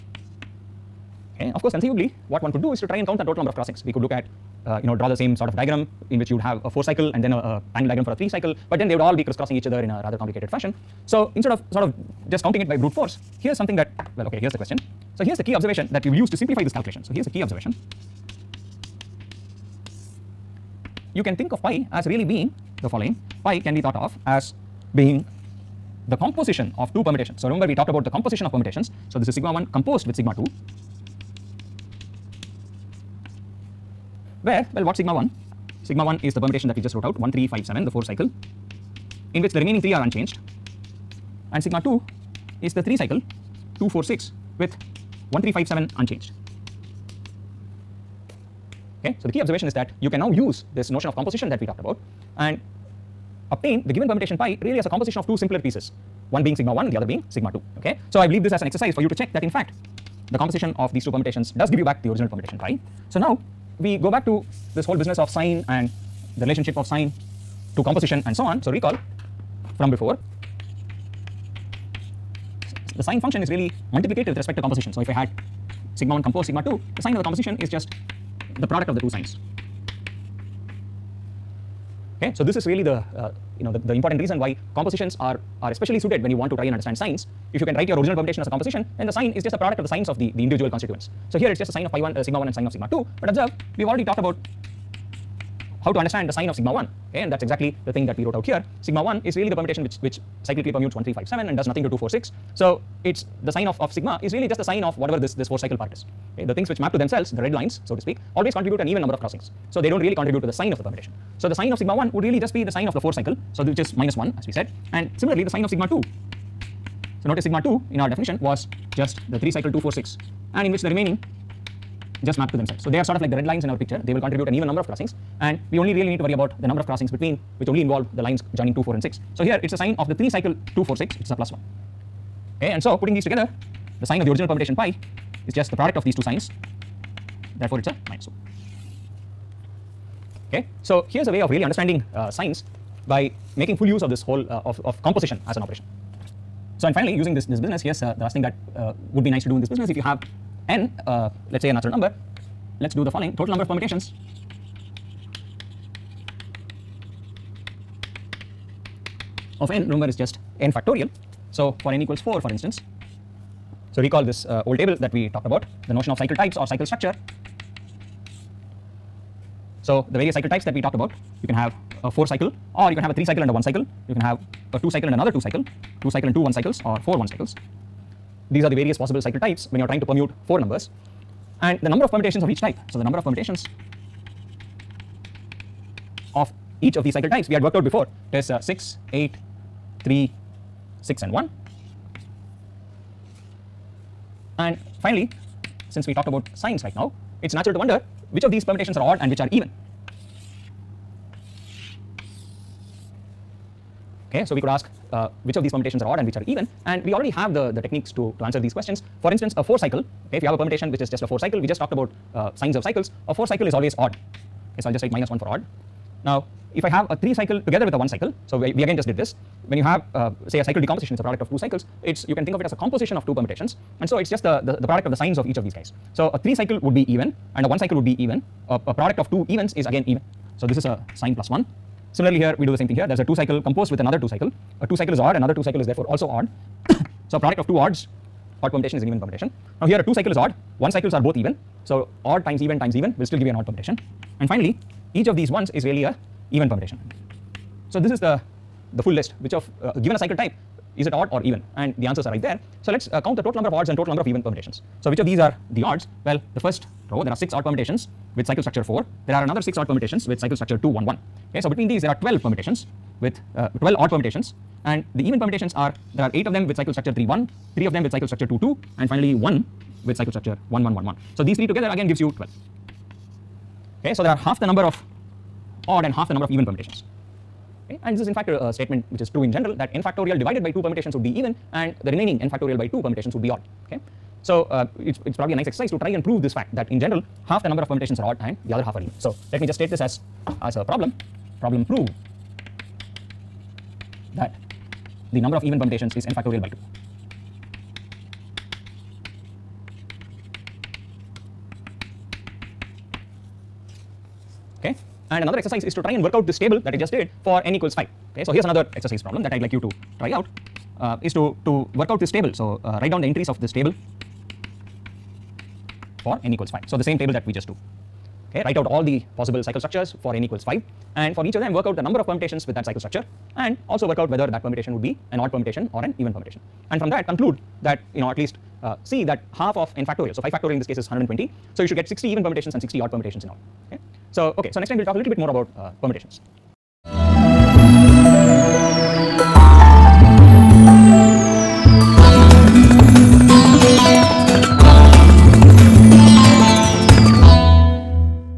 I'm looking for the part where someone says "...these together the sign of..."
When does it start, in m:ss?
2:13.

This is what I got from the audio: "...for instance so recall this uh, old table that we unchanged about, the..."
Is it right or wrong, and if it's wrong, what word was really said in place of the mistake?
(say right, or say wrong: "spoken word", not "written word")
wrong: "talked", not "unchanged".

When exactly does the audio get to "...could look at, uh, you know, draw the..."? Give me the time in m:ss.
0:03.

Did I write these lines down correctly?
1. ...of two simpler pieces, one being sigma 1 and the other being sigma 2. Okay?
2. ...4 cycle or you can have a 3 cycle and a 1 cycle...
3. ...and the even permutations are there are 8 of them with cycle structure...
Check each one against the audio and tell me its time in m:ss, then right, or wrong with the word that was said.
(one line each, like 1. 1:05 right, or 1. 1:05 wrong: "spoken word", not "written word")
1. 0:55 right
2. 2:52 right
3. 4:24 right.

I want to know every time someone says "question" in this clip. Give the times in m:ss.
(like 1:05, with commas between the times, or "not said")
0:14, 3:28.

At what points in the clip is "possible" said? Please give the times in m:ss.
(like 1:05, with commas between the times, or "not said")
2:58, 5:19.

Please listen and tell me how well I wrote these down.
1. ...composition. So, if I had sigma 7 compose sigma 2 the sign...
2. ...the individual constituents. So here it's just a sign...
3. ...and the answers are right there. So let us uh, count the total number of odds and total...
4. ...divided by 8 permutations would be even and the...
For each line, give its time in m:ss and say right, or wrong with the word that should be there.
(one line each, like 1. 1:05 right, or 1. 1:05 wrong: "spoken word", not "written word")
1. 1:14 wrong: "1", not "7"
2. 1:30 right
3. 4:11 right
4. 4:40 wrong: "2", not "8".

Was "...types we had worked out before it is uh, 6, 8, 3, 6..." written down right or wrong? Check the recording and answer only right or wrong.
right.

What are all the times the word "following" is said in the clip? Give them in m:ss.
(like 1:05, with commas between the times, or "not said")
0:22, 2:33.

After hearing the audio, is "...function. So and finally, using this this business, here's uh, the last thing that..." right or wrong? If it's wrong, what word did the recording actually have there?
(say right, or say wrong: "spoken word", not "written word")
wrong: "operation", not "function".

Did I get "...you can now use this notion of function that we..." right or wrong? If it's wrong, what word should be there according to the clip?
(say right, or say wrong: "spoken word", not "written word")
wrong: "composition", not "function".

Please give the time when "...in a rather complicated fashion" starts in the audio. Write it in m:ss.
0:09.